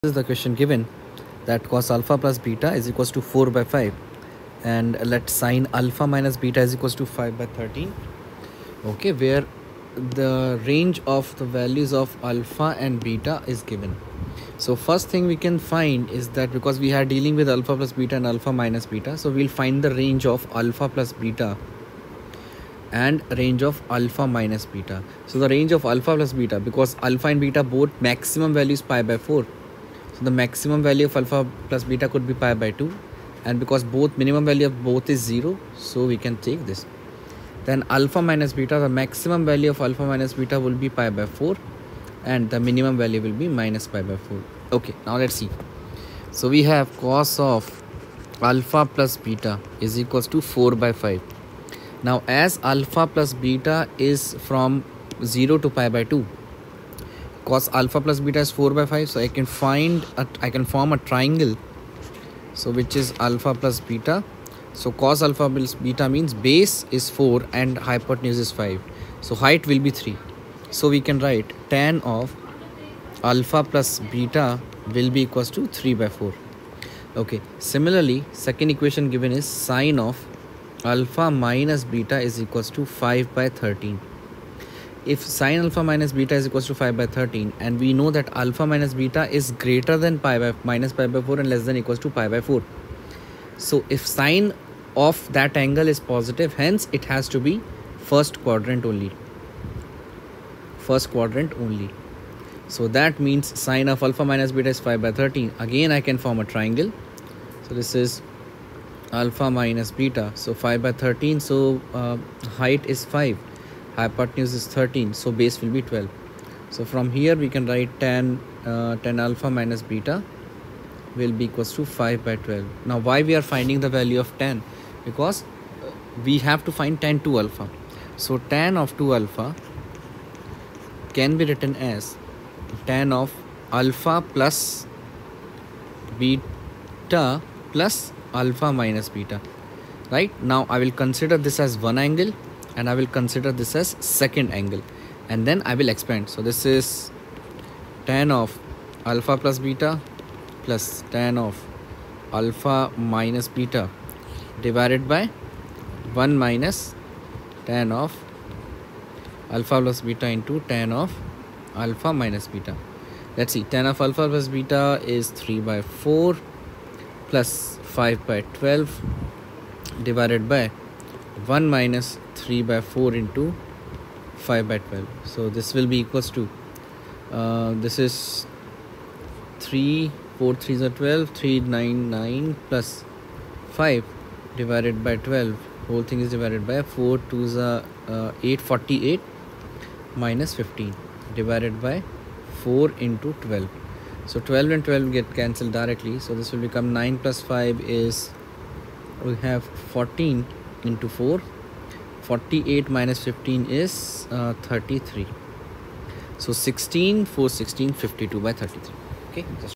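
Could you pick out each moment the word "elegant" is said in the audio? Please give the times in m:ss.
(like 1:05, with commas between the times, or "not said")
not said.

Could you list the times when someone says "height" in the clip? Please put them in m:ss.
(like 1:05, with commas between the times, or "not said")
1:09, 1:52.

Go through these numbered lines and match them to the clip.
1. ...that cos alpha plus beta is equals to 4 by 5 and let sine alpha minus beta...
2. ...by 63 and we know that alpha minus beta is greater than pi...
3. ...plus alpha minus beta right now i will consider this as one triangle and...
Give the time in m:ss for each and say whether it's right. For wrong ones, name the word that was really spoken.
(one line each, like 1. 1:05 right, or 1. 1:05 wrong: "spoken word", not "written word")
1. 0:01 right
2. 1:26 wrong: "13", not "63"
3. 2:17 wrong: "angle", not "triangle".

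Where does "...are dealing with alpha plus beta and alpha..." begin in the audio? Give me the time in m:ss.
0:16.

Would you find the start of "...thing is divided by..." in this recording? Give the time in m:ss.
3:06.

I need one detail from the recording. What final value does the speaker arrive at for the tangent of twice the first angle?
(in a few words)
52/33.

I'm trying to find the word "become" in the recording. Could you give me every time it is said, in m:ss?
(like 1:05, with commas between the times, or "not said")
3:16.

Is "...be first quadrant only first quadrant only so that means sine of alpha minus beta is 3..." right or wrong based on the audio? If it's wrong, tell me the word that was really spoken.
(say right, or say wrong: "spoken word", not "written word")
wrong: "5", not "3".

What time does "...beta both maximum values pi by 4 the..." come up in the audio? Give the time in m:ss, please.
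0:27.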